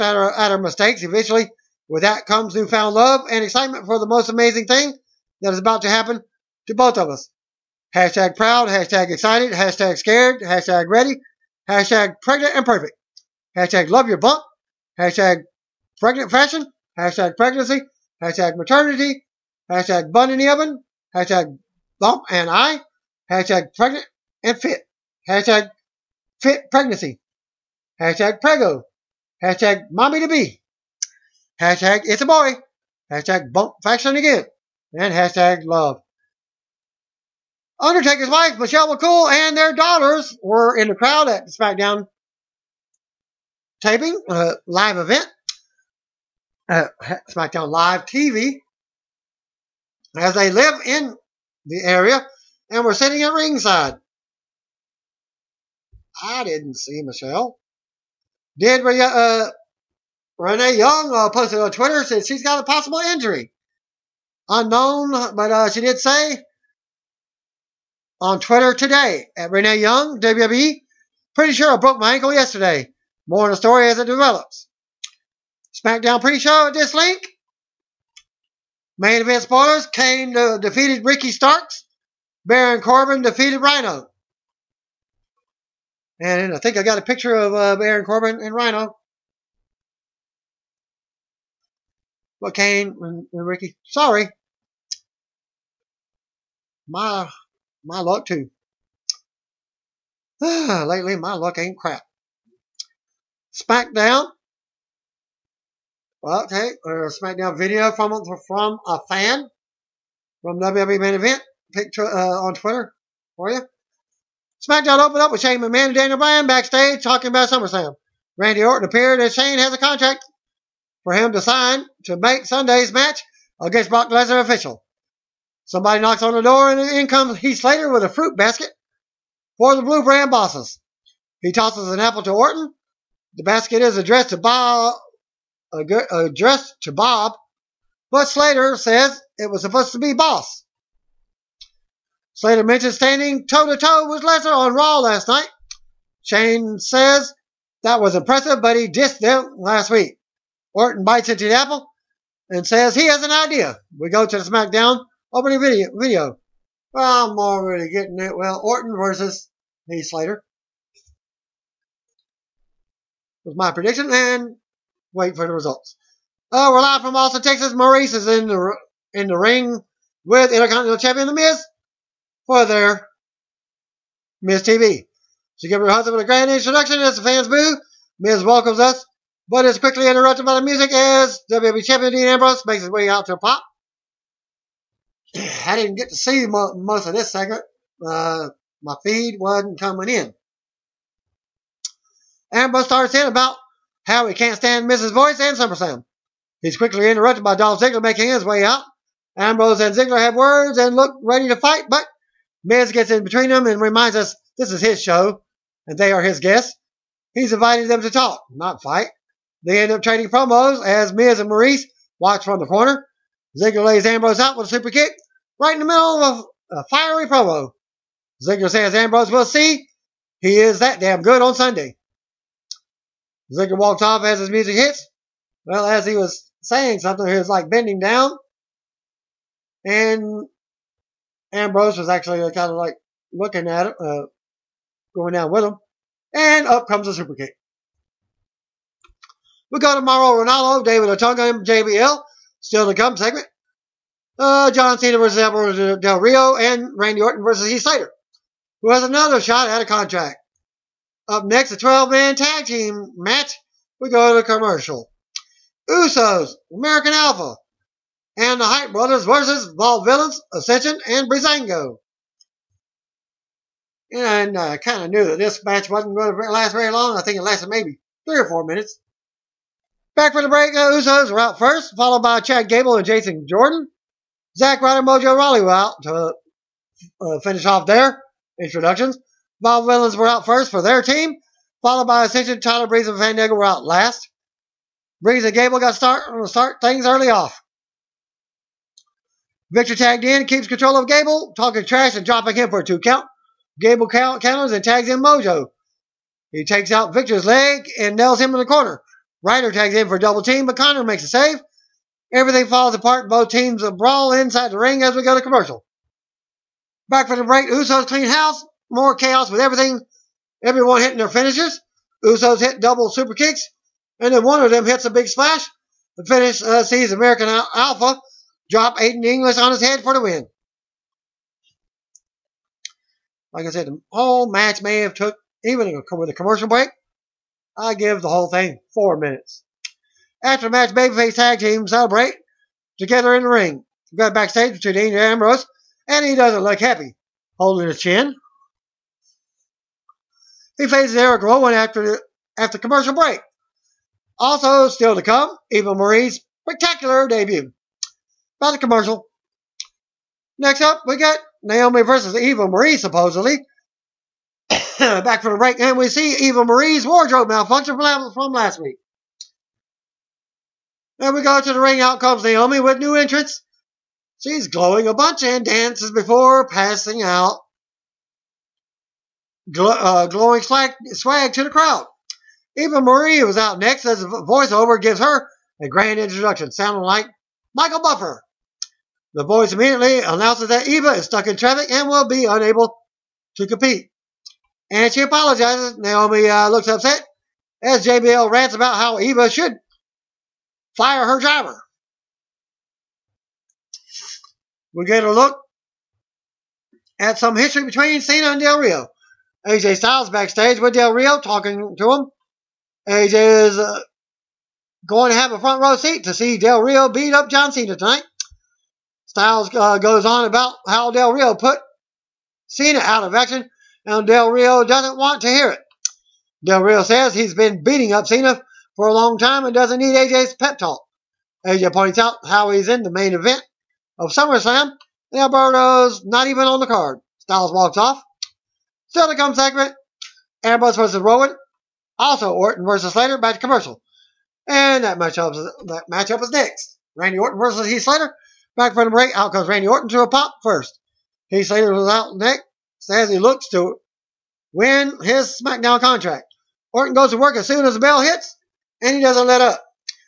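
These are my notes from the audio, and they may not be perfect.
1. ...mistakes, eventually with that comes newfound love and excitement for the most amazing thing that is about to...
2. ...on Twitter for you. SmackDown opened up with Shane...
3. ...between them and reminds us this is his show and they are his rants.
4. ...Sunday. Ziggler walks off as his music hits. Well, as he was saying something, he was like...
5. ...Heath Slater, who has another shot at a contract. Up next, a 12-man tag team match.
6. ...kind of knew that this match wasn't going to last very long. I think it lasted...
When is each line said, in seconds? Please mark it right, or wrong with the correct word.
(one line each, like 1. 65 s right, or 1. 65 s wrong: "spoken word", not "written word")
1. 0 s right
2. 112 s right
3. 203 s wrong: "guests", not "rants"
4. 221 s right
5. 247 s right
6. 264 s right.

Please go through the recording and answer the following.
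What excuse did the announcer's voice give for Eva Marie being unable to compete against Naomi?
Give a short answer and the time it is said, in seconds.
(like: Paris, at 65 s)
Stuck in traffic, at 381 s.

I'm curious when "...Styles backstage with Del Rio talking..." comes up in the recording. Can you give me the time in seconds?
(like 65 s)
399 s.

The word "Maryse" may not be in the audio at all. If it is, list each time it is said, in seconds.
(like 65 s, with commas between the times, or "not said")
167 s, 211 s.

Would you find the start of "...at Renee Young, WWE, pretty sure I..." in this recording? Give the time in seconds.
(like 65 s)
69 s.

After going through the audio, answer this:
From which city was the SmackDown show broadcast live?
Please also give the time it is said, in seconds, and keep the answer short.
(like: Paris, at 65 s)
Austin, Texas, at 167 s.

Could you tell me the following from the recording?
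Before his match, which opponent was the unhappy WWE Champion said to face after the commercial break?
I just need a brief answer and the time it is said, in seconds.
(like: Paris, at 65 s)
Eric Rowan, at 341 s.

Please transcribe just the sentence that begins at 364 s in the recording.
She's glowing a bunch and dances before passing out.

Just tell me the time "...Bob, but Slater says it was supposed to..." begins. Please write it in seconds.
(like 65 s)
136 s.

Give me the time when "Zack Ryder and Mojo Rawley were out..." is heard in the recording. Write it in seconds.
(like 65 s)
274 s.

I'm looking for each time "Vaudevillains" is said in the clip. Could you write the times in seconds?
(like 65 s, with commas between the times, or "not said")
259 s, 279 s.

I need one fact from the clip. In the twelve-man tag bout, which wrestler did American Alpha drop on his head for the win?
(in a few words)
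Aiden English.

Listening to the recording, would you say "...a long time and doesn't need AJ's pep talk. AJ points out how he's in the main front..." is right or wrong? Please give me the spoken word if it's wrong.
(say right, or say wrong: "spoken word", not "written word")
wrong: "event", not "front".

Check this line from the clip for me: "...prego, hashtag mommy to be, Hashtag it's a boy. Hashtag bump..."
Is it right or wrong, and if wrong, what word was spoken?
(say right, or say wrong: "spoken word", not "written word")
right.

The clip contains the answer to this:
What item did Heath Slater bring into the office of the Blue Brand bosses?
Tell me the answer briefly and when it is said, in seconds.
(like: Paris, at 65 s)
A fruit basket, at 128 s.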